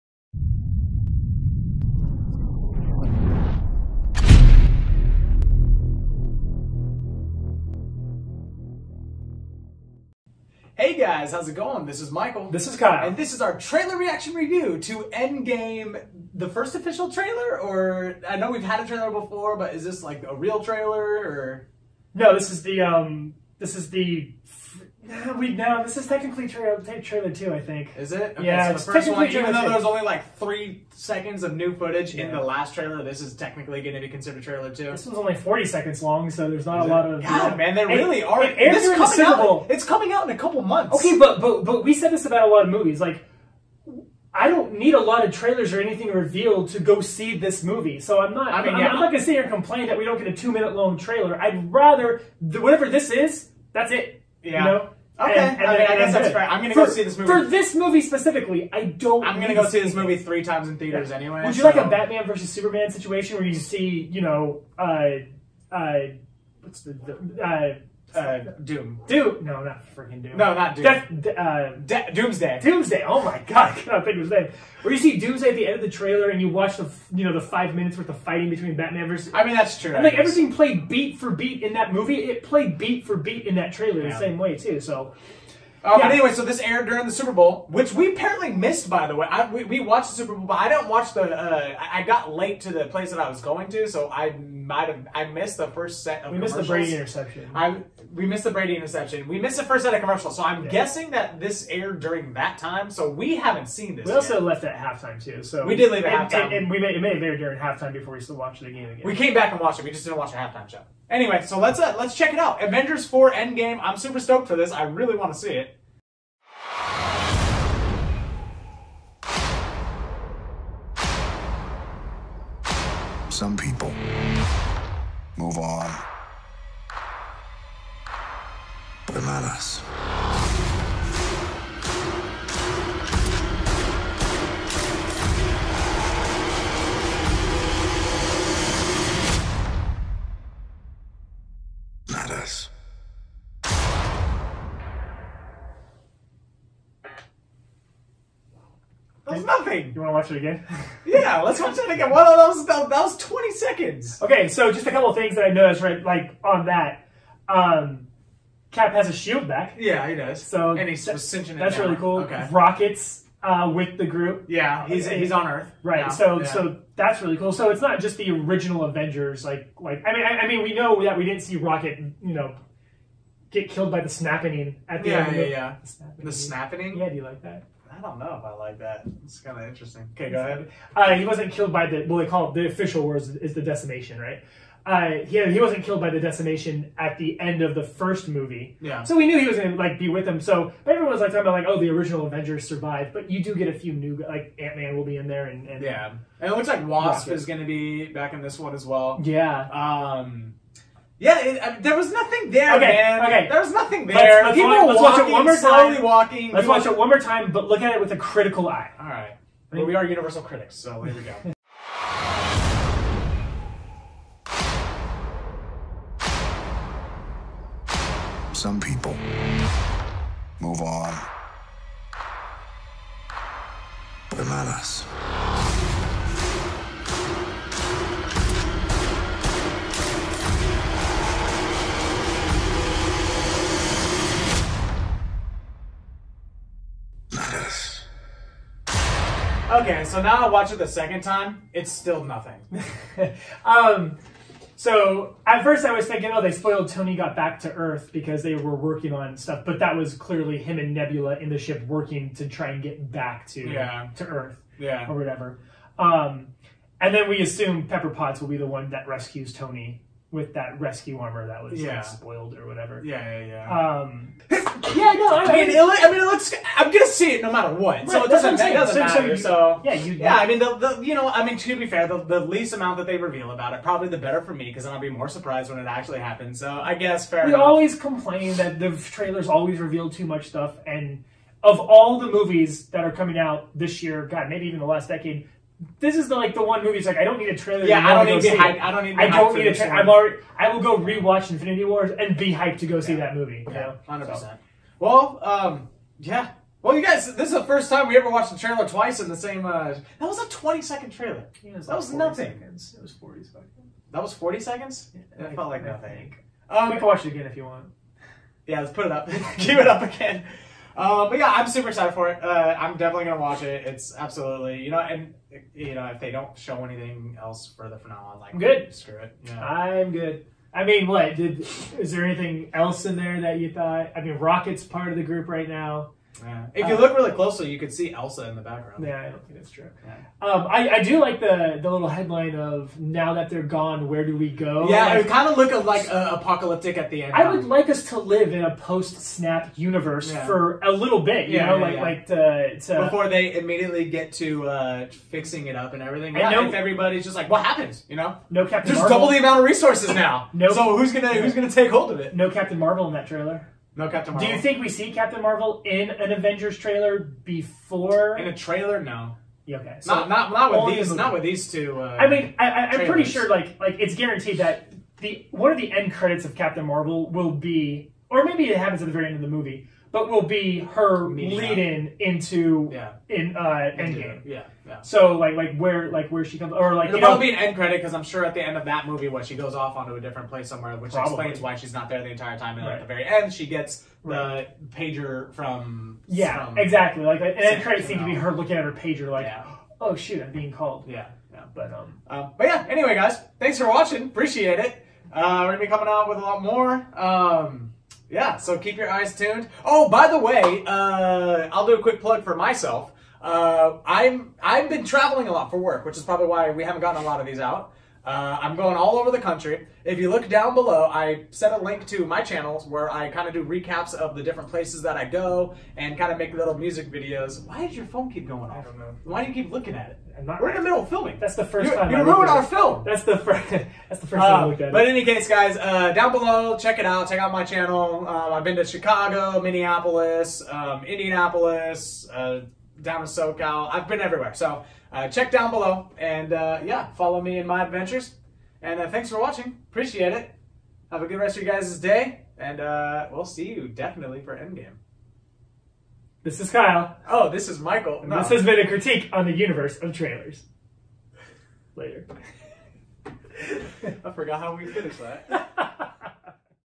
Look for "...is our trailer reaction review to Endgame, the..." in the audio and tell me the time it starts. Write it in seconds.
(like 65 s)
13 s.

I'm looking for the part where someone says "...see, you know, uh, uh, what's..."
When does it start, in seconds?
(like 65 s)
63 s.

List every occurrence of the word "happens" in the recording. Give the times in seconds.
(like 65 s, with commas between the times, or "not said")
276 s, 347 s, 368 s.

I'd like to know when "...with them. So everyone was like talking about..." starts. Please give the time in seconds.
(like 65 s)
190 s.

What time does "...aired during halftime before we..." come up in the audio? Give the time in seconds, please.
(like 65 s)
107 s.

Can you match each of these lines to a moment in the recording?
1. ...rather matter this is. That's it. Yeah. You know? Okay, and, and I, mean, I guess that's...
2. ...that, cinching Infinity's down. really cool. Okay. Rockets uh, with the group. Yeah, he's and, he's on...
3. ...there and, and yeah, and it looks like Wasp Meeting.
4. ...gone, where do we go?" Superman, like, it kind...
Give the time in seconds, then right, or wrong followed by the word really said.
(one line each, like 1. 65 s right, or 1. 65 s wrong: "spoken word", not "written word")
1. 51 s wrong: "whatever", not "matter"
2. 161 s wrong: "That", not "Infinity"
3. 195 s wrong: "Rocket", not "Meeting"
4. 333 s wrong: "Yeah", not "Superman".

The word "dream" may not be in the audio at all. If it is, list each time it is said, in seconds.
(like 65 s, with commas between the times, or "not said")
not said.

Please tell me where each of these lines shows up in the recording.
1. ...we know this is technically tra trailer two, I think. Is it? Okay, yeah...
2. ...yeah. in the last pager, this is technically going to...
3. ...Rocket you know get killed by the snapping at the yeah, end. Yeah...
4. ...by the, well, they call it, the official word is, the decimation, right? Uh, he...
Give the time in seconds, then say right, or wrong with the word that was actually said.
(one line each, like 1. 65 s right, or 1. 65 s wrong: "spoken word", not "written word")
1. 25 s right
2. 32 s wrong: "trailer", not "pager"
3. 171 s right
4. 181 s right.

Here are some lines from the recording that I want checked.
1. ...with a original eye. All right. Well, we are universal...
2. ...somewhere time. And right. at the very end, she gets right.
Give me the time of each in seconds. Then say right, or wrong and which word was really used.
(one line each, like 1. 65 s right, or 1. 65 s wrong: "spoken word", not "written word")
1. 208 s wrong: "critical", not "original"
2. 382 s wrong: "entire", not "somewhere".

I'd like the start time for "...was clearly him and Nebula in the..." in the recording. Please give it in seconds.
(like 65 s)
249 s.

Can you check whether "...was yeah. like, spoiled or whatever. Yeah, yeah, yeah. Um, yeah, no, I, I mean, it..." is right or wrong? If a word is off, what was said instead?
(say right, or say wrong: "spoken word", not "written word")
right.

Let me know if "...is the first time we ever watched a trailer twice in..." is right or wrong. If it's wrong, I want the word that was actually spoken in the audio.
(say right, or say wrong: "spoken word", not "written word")
right.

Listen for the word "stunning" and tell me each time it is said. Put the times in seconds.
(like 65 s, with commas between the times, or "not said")
not said.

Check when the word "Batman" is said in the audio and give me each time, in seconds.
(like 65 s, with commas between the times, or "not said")
61 s, 78 s.